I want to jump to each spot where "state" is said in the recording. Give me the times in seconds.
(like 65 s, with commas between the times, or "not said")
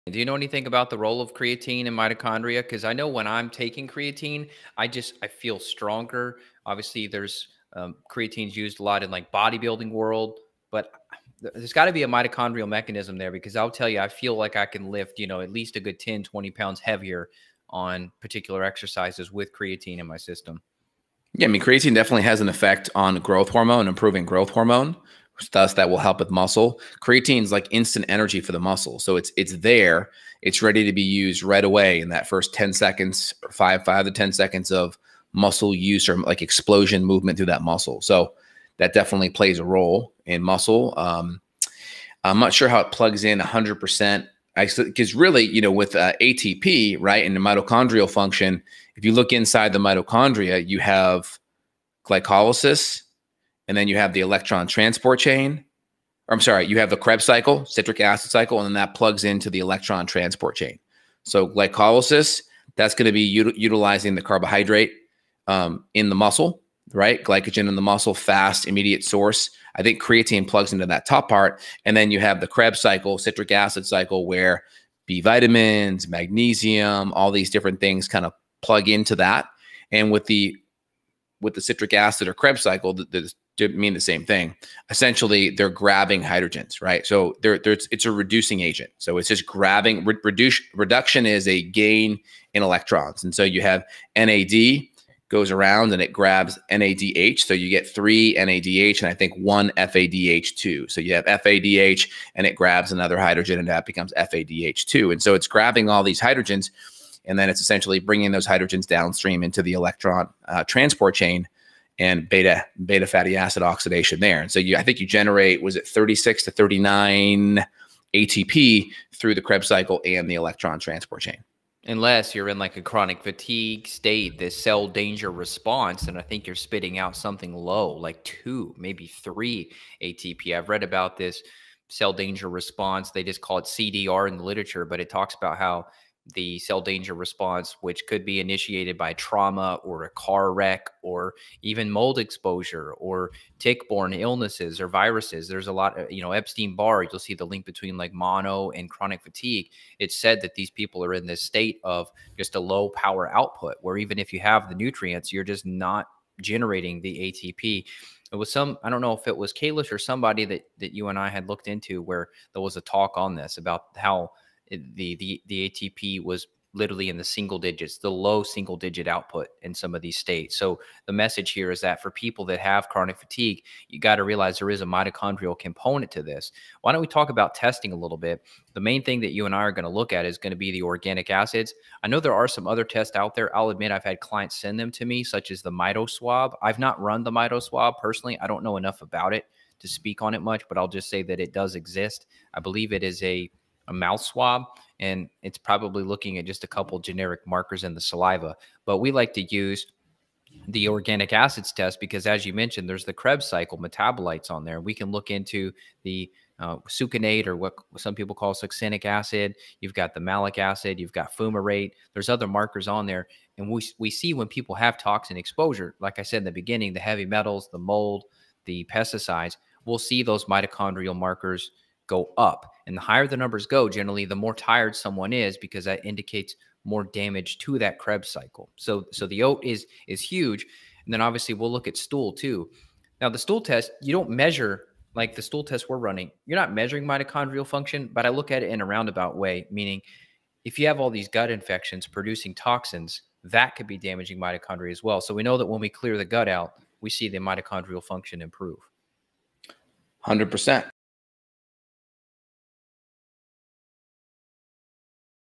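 123 s, 151 s, 170 s.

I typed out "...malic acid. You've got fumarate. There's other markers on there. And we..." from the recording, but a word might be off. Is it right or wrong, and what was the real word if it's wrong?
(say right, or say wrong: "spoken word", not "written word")
right.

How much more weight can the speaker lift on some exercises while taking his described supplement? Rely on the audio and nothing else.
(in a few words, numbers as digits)
10 to 20 pounds.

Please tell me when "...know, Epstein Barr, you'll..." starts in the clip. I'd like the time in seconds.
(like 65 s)
146 s.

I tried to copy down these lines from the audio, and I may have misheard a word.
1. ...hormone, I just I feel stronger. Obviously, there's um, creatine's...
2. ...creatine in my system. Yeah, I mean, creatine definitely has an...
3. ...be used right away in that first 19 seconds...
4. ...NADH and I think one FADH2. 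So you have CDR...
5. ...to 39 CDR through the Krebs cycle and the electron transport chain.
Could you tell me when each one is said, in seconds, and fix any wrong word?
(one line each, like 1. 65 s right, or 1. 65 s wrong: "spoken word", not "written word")
1. 3 s wrong: "creatine", not "hormone"
2. 19 s right
3. 30 s wrong: "10", not "19"
4. 98 s wrong: "FADH", not "CDR"
5. 116 s wrong: "ATP", not "CDR".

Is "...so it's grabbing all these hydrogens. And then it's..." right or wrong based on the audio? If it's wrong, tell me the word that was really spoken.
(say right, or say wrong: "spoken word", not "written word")
right.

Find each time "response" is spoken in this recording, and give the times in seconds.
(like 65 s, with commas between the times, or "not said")
125 s, 132 s, 137 s.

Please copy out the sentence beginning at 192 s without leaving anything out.
I believe it is a a mouth swab, and it's probably looking at just a couple generic markers in the saliva.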